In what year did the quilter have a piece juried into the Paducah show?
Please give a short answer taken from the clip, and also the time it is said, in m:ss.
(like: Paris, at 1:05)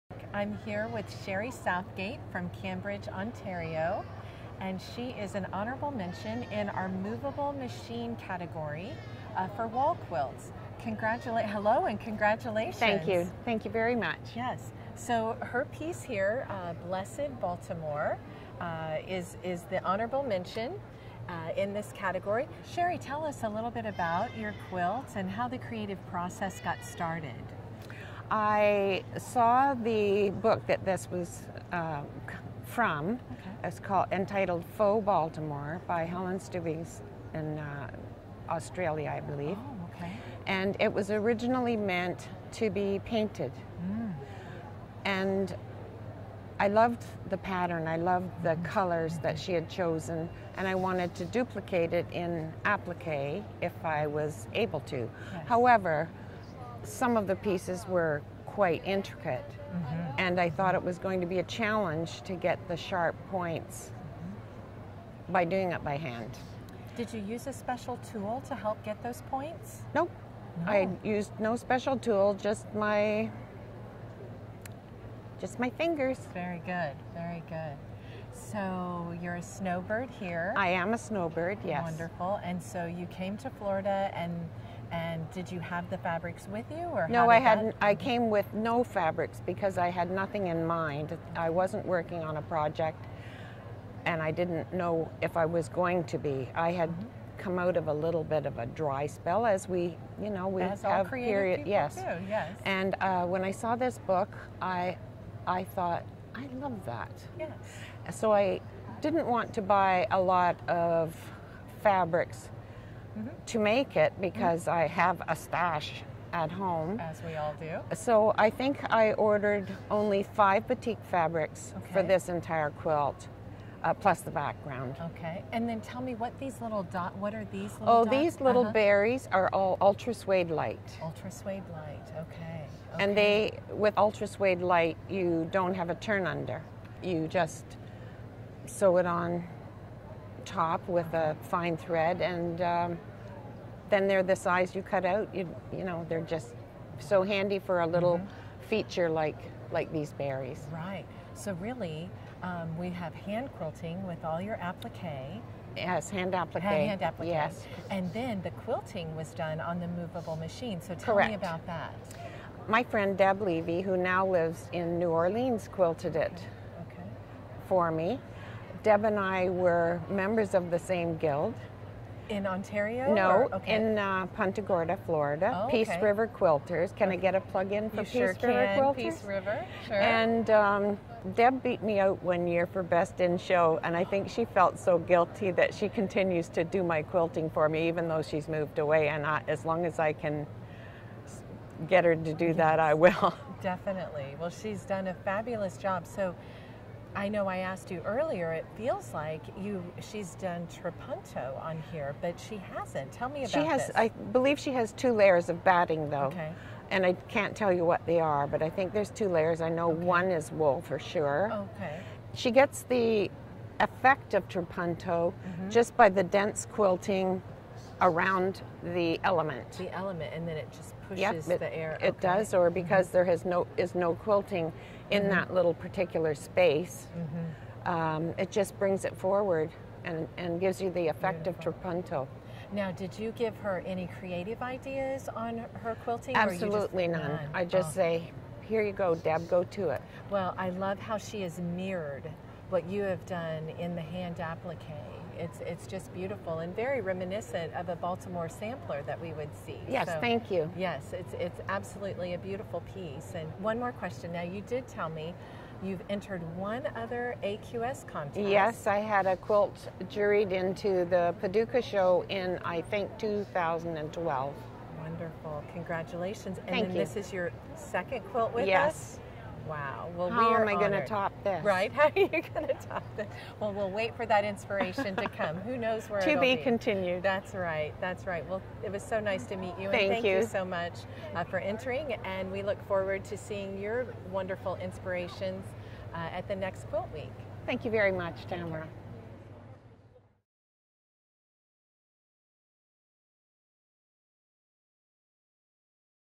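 2012, at 4:23.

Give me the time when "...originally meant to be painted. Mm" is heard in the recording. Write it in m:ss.
0:41.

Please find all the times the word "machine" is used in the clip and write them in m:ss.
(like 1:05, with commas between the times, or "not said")
0:07, 2:40.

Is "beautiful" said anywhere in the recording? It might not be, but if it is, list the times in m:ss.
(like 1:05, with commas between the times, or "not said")
3:51, 4:06, 4:12.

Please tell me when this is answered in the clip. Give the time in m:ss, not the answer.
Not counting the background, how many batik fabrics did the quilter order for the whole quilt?
2:00.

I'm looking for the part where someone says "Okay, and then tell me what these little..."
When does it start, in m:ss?
2:05.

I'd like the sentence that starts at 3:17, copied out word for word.
I know I asked you earlier.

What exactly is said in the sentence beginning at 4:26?
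this is your second quilt with yes.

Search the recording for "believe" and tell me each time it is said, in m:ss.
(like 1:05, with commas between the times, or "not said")
0:39, 3:24.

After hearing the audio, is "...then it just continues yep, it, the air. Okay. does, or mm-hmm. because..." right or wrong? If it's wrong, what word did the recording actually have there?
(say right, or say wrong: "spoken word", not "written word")
wrong: "pushes", not "continues".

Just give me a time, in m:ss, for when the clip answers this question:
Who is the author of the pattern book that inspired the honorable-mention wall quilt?
0:36.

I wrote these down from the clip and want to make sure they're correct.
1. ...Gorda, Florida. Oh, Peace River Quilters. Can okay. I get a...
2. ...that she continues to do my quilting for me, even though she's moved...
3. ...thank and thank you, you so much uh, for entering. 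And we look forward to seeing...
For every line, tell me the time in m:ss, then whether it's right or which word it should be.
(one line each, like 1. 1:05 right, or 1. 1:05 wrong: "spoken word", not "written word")
1. 2:54 right
2. 3:05 right
3. 4:39 right.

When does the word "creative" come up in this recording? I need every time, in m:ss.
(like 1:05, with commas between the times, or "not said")
0:25, 3:54.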